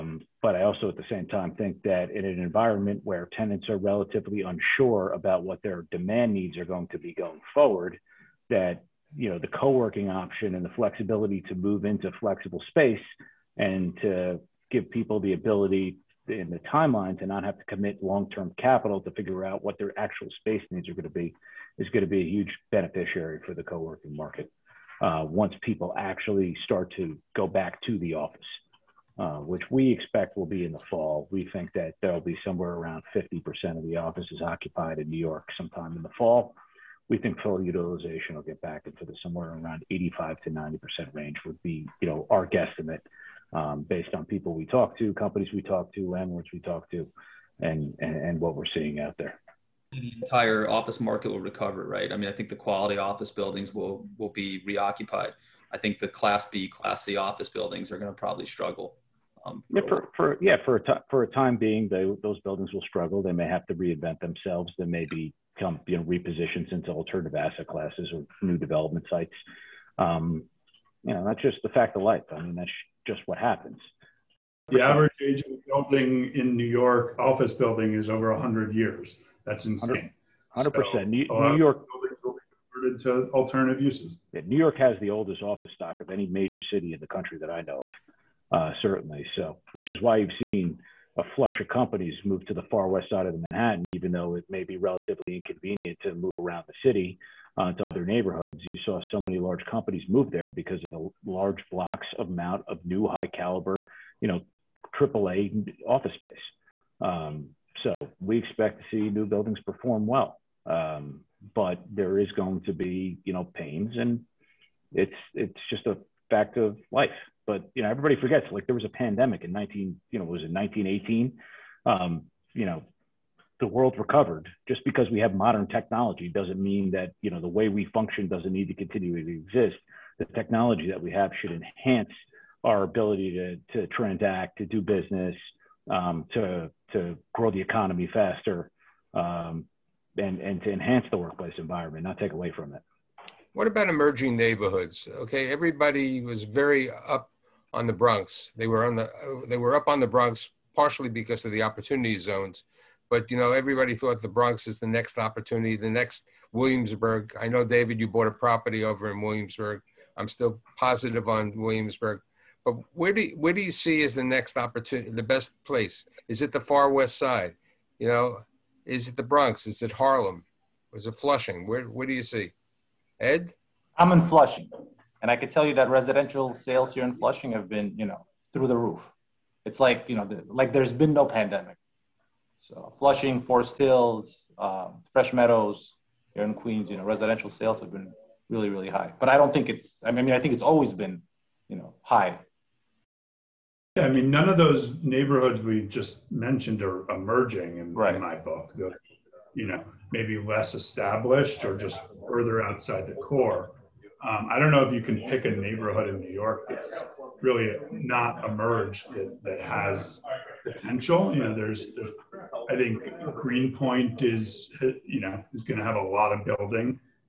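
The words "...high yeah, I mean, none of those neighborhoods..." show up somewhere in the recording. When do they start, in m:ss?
3:12.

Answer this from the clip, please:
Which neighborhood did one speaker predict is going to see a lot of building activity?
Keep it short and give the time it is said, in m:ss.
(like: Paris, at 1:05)
Greenpoint, at 3:33.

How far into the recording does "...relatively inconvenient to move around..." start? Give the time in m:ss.
1:34.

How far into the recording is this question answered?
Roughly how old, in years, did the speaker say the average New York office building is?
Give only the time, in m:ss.
1:18.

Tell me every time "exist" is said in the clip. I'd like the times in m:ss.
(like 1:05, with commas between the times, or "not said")
2:09.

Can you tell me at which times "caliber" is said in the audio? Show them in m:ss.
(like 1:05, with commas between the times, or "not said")
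1:43.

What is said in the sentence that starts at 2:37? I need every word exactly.
I know David, you bought a property over in Williamsburg.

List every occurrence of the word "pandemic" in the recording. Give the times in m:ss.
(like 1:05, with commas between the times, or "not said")
1:58, 3:01.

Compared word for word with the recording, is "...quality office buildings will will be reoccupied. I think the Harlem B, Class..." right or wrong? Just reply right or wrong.
wrong.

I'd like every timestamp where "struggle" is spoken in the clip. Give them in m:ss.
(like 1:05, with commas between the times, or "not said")
0:58, 1:02.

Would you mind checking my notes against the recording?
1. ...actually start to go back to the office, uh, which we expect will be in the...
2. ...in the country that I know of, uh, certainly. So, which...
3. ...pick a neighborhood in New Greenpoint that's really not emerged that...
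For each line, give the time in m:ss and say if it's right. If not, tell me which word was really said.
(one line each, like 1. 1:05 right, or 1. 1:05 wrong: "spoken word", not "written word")
1. 0:25 right
2. 1:26 right
3. 3:25 wrong: "York", not "Greenpoint".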